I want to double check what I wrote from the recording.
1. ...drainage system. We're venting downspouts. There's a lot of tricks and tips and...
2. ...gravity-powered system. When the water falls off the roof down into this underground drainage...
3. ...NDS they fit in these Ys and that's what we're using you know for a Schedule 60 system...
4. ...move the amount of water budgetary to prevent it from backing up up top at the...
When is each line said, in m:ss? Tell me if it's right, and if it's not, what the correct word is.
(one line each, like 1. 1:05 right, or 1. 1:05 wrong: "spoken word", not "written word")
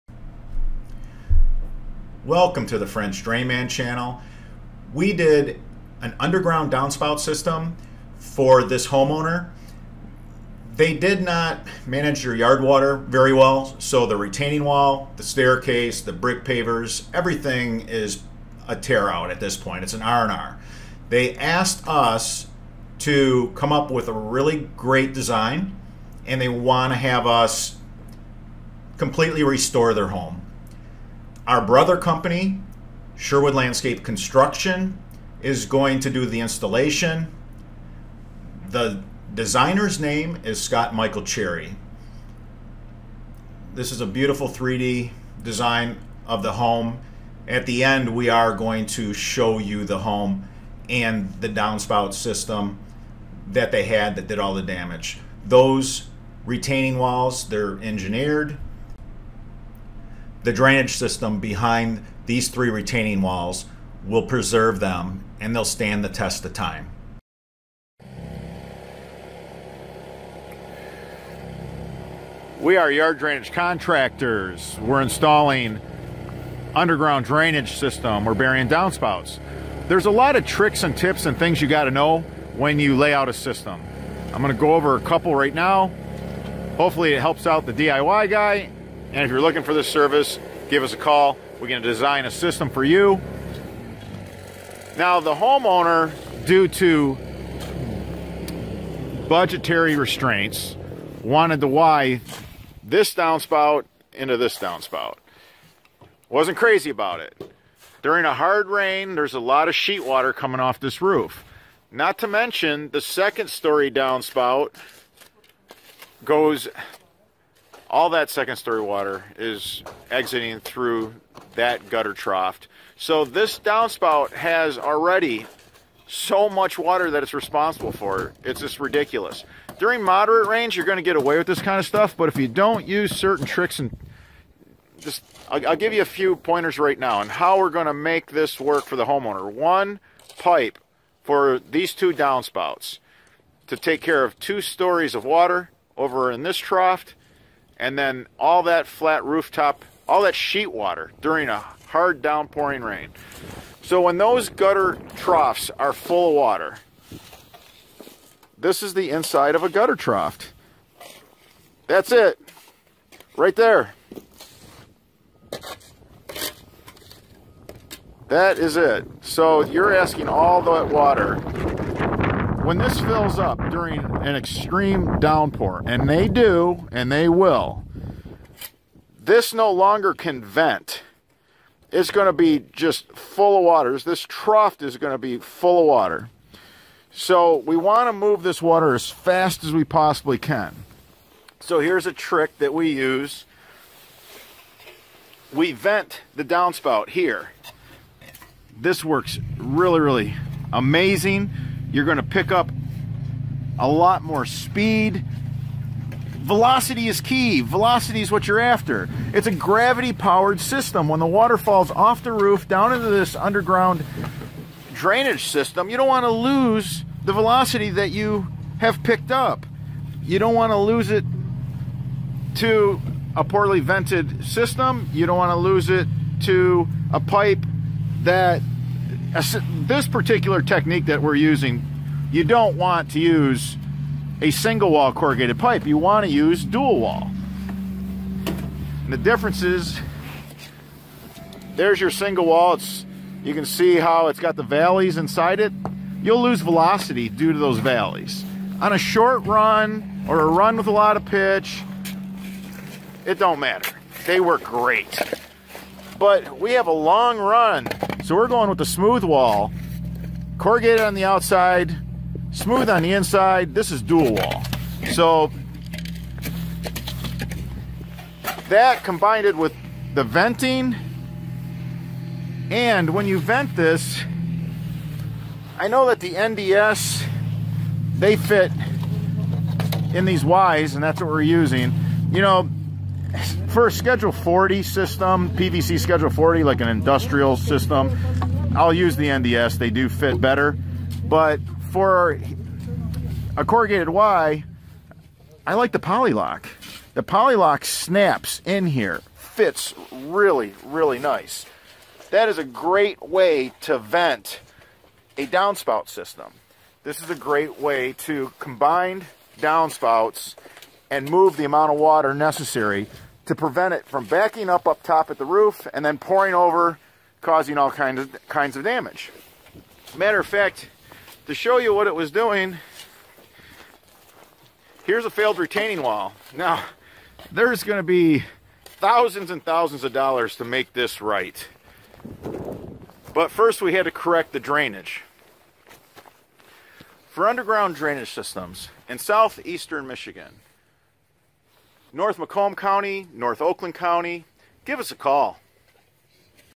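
1. 1:17 wrong: "burying", not "venting"
2. 3:29 right
3. 4:36 wrong: "40", not "60"
4. 5:11 wrong: "necessary", not "budgetary".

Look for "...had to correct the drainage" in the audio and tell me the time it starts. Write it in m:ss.
5:33.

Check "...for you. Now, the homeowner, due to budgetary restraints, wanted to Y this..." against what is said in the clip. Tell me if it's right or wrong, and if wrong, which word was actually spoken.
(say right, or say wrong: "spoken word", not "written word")
right.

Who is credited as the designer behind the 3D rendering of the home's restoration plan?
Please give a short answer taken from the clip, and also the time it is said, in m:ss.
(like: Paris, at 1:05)
Scott Michael Cherry, at 0:40.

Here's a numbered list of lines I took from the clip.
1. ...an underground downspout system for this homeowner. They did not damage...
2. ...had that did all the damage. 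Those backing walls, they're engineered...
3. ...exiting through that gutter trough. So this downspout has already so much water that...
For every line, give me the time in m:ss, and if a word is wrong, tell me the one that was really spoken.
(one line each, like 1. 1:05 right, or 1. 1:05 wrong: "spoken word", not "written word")
1. 0:06 wrong: "manage", not "damage"
2. 0:53 wrong: "retaining", not "backing"
3. 2:00 right.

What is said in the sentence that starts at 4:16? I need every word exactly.
But we have a long run so we're going with the smooth wall, corrugated on the outside, smooth on the inside.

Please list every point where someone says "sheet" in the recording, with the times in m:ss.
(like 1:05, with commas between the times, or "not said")
1:49, 2:30.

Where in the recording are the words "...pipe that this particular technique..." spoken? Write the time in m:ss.
3:47.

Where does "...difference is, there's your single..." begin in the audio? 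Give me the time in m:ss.
3:59.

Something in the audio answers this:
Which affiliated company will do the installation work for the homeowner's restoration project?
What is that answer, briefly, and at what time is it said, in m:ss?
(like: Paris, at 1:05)
Sherwood Landscape Construction, at 0:33.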